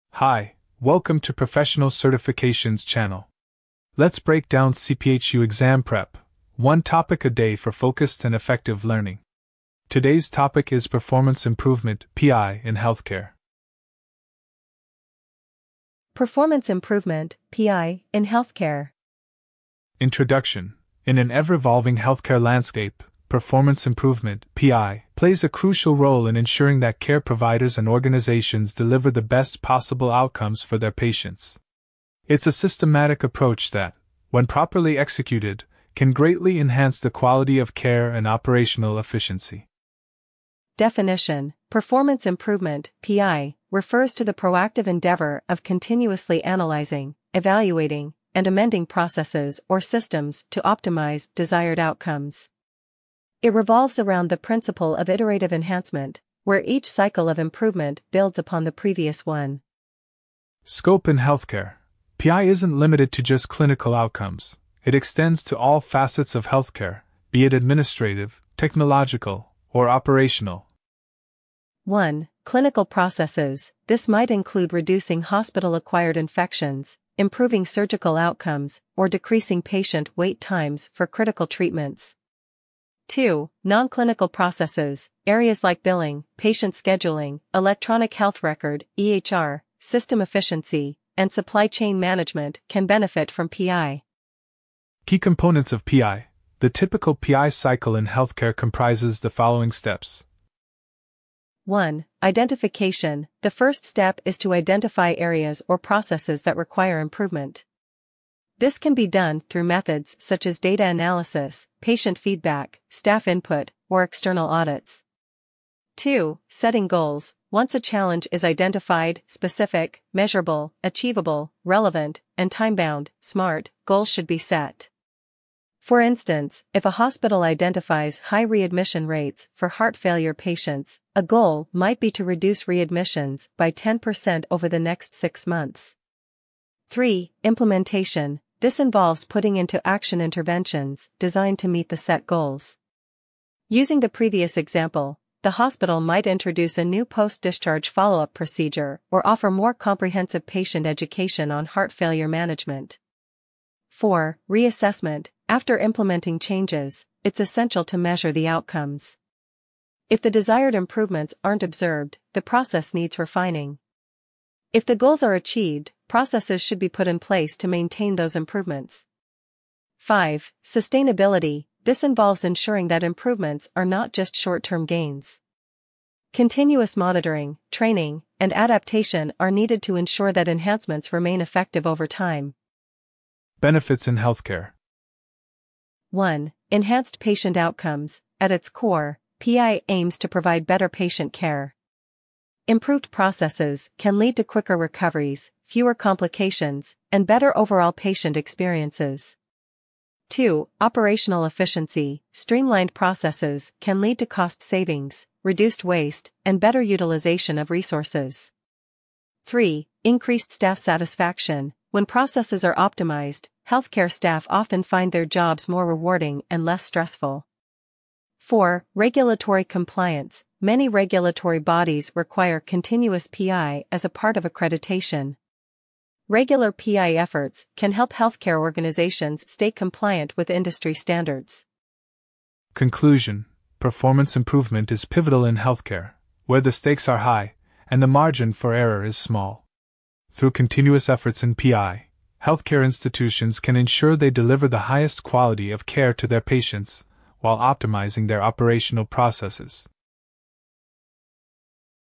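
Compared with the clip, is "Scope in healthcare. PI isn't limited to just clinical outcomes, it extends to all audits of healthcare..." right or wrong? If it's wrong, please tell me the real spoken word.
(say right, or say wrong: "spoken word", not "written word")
wrong: "facets", not "audits".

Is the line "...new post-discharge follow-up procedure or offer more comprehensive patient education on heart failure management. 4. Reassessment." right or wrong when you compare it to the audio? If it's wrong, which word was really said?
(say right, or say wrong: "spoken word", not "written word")
right.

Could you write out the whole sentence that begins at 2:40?
If the desired improvements aren't observed, the process needs refining.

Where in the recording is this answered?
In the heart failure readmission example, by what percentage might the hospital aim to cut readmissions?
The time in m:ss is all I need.
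2:13.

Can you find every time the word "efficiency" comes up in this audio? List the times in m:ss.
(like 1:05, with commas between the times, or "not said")
0:38, 1:30, 3:21.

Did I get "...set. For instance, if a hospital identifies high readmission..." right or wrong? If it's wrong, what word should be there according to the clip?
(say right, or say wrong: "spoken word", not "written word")
right.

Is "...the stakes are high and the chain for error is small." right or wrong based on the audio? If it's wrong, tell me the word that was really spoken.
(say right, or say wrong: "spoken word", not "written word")
wrong: "margin", not "chain".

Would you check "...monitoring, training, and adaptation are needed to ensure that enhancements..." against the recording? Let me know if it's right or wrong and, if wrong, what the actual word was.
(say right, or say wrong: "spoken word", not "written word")
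right.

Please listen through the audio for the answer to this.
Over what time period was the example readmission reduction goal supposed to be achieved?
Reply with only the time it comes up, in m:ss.
2:15.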